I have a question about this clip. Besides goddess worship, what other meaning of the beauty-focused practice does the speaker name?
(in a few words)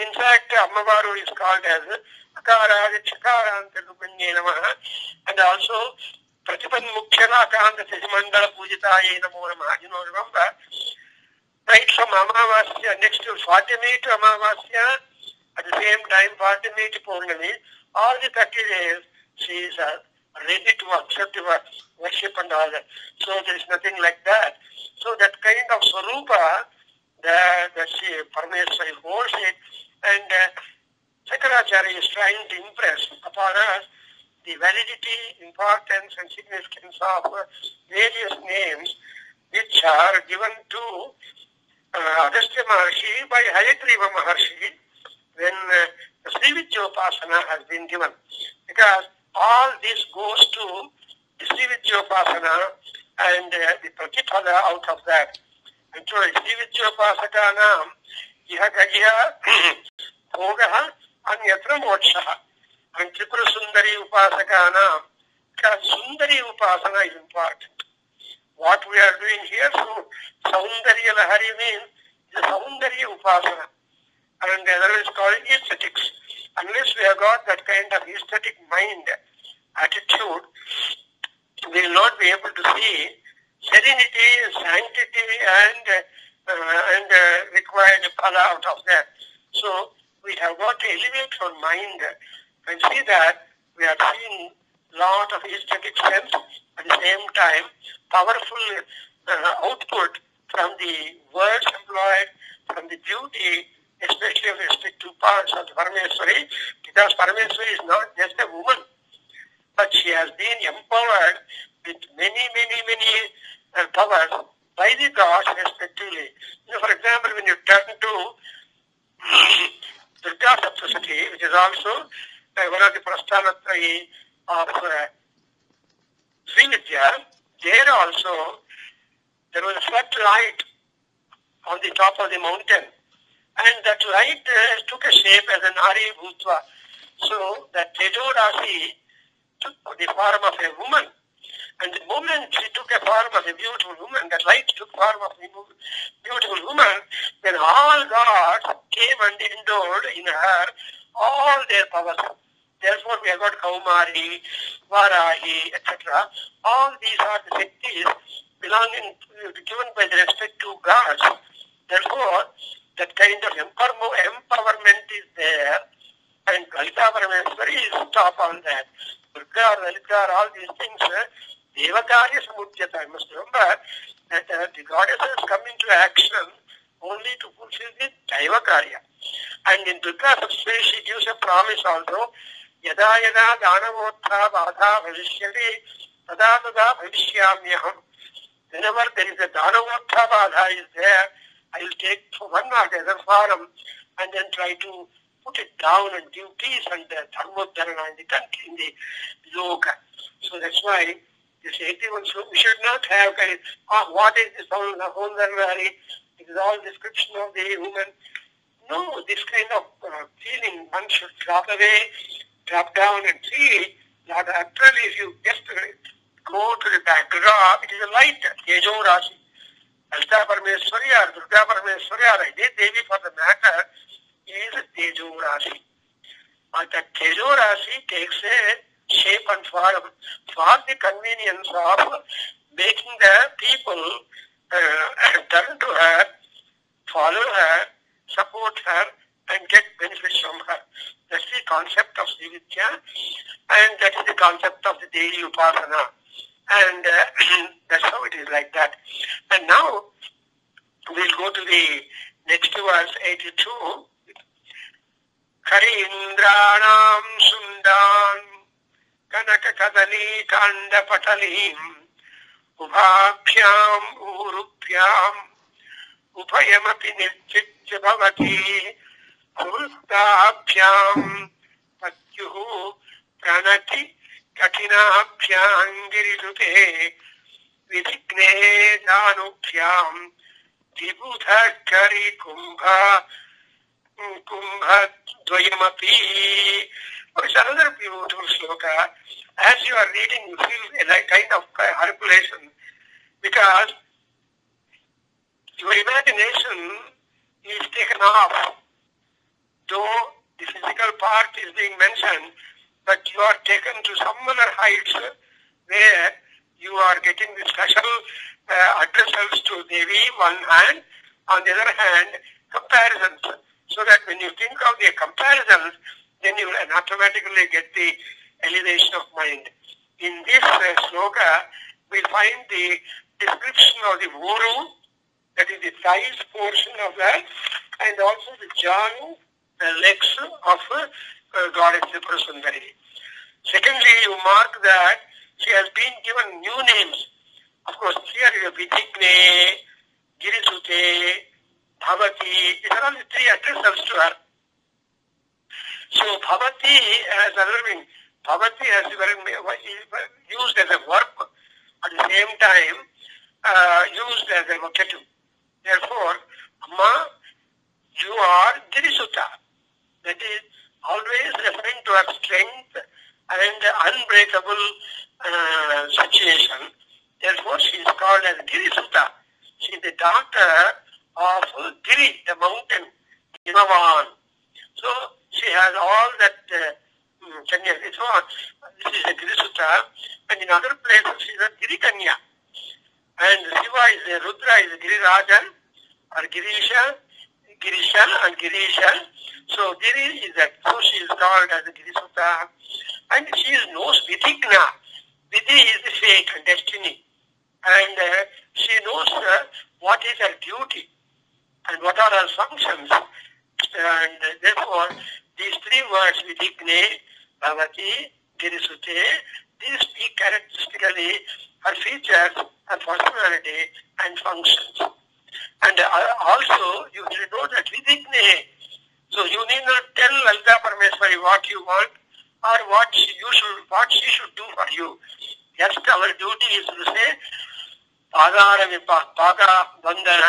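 aesthetics.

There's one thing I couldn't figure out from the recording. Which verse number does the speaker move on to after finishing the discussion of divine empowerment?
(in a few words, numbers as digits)
82.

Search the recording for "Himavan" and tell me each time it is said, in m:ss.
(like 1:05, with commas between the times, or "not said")
6:13.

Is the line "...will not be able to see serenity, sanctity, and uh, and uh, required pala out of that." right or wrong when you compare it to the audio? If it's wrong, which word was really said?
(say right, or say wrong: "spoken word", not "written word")
right.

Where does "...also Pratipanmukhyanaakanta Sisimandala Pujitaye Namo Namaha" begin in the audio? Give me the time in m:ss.
0:05.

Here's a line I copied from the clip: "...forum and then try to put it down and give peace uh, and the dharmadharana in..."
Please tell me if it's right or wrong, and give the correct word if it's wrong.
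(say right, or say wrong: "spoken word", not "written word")
right.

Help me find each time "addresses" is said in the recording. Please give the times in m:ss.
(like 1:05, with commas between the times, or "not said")
5:09, 5:43.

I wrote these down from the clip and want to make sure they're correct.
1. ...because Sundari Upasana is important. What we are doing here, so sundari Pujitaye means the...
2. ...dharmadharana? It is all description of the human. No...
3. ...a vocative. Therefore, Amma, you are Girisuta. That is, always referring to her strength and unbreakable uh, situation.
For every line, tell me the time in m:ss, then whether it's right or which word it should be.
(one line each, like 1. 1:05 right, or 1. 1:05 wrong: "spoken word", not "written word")
1. 1:05 wrong: "Lahari", not "Pujitaye"
2. 3:24 right
3. 5:54 right.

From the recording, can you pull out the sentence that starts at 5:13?
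So that when you think of the comparisons, then you will automatically get the elevation of mind.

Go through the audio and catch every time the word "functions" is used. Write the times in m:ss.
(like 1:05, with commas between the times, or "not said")
6:42, 6:54.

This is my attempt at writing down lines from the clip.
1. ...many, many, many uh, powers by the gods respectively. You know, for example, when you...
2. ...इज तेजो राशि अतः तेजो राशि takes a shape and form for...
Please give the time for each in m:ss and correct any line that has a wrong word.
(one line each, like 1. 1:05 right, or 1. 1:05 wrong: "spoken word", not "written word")
1. 1:52 right
2. 3:44 right.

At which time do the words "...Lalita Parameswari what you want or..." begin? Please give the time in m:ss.
7:00.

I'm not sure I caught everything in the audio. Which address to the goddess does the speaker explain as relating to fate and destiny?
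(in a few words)
Vidigna.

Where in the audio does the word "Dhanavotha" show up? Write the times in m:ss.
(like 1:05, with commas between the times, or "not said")
3:09.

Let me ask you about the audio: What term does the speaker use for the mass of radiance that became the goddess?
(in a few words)
Tejo Rasi.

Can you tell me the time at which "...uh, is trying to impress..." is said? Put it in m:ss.
0:30.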